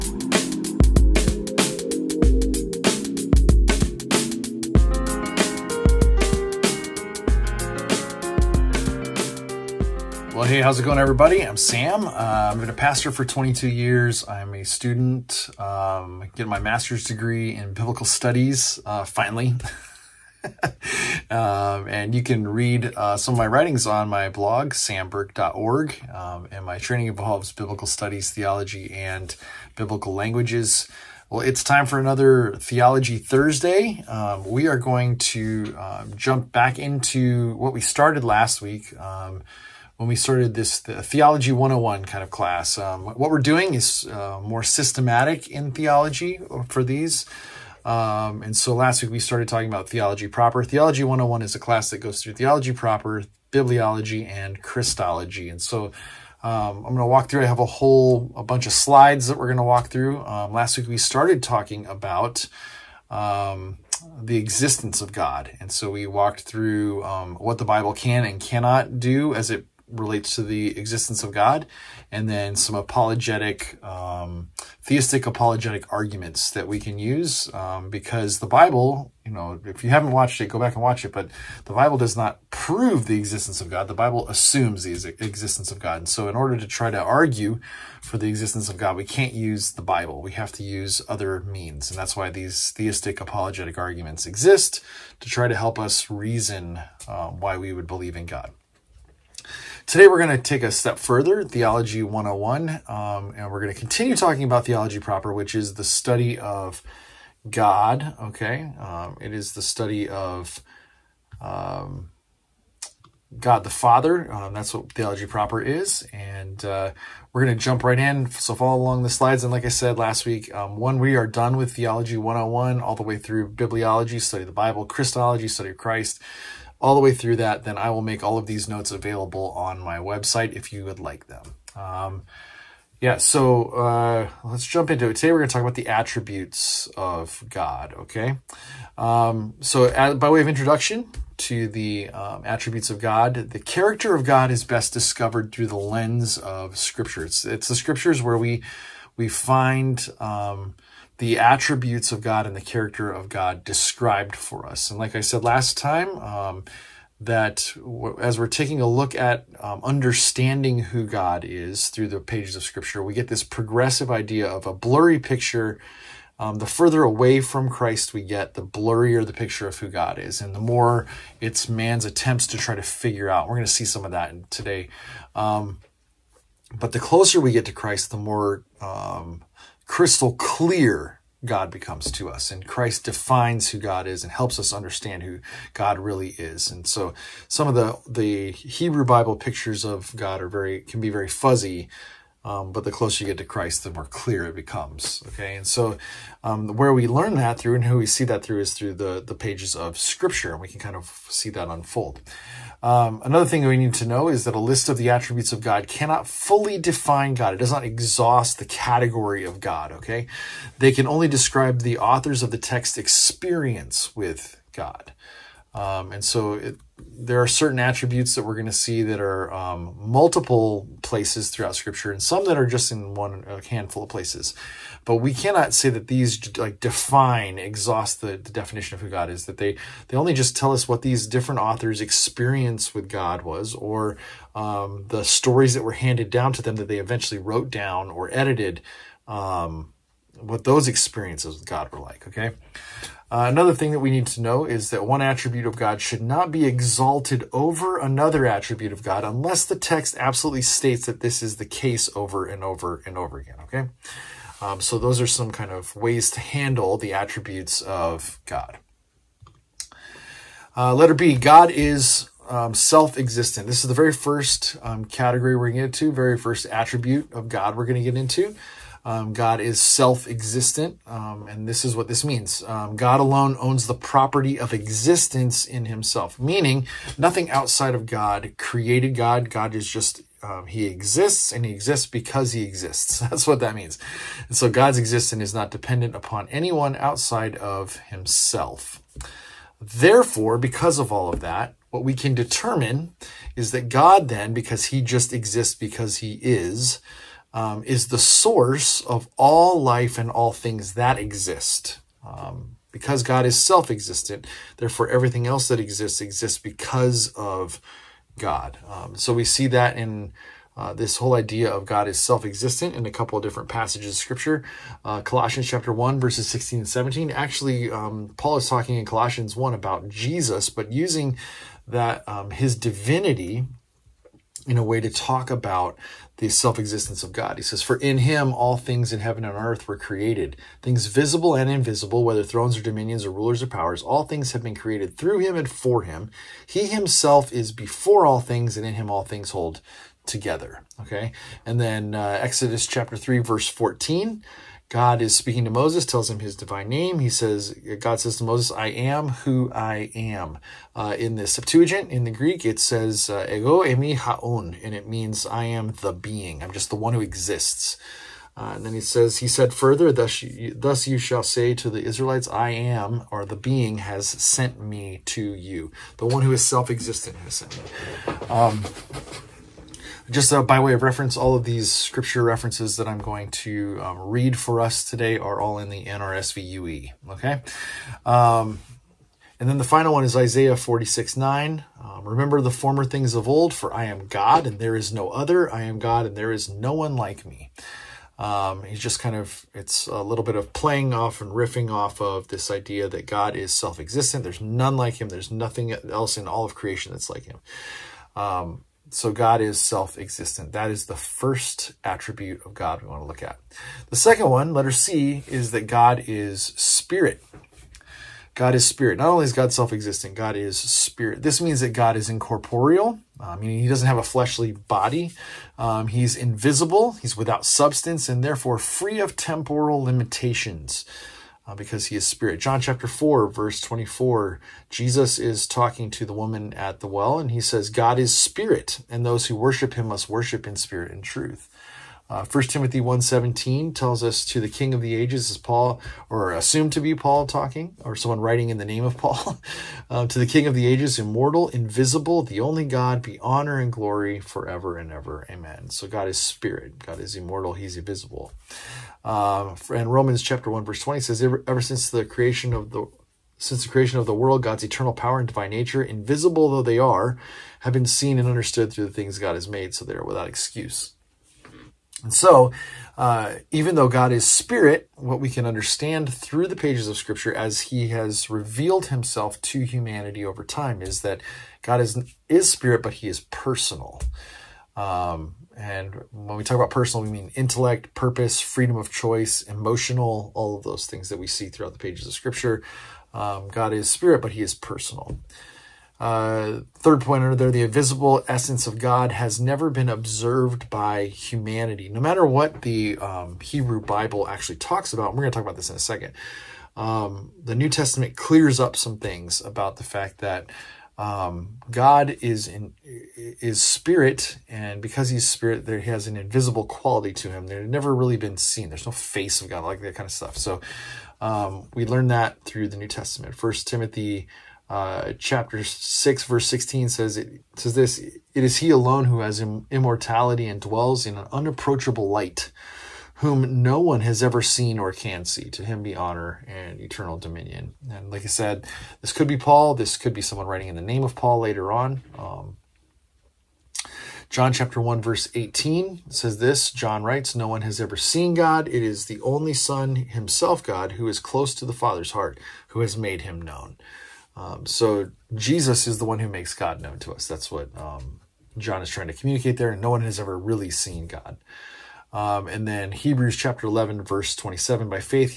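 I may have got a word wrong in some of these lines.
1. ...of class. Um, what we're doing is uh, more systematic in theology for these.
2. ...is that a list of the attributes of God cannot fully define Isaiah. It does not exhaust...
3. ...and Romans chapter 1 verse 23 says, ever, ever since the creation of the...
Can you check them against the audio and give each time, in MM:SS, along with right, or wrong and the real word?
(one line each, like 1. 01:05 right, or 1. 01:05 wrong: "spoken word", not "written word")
1. 00:42 right
2. 03:24 wrong: "God", not "Isaiah"
3. 07:29 wrong: "20", not "23".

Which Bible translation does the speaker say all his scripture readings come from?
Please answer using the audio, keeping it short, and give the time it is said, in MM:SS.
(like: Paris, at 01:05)
NRSVUE, at 06:16.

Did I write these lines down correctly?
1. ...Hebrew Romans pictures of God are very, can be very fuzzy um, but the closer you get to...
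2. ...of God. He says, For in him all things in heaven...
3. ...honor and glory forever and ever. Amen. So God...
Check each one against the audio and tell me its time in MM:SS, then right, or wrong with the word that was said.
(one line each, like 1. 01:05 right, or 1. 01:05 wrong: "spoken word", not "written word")
1. 03:08 wrong: "Bible", not "Romans"
2. 05:27 right
3. 07:23 right.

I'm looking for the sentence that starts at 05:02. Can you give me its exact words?
Um, because God is self existent, therefore everything else that exists exists because of God.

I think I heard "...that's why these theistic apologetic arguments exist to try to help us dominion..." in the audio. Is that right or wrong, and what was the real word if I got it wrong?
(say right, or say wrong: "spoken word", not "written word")
wrong: "reason", not "dominion".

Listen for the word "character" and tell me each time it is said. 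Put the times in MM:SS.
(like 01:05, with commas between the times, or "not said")
02:23, 02:32.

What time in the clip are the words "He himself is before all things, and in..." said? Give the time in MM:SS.
05:36.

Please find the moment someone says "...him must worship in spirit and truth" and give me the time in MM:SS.
07:09.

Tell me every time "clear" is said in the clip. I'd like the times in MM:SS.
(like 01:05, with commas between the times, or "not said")
03:00, 03:14, 08:18.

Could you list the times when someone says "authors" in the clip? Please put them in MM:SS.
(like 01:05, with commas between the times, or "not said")
03:31, 03:51.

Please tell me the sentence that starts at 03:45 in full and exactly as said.
But we cannot say that these like define, exhaust the, the definition of who God is.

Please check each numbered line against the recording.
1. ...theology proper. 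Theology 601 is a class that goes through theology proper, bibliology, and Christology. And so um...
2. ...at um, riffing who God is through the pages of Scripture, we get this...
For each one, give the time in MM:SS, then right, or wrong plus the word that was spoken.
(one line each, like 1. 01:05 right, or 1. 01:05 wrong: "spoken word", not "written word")
1. 00:49 wrong: "101", not "601"
2. 02:39 wrong: "understanding", not "riffing".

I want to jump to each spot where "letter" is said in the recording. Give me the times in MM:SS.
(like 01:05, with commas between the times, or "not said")
04:20, 06:44.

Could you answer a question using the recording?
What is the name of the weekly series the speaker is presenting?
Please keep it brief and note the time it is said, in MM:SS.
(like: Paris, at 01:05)
Theology Thursday, at 00:32.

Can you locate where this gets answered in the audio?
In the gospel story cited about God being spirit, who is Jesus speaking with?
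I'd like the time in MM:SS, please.
07:06.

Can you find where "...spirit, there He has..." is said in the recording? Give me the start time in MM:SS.
08:25.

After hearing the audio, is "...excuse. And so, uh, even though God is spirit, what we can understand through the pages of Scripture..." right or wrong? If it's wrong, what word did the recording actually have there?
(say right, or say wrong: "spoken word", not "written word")
right.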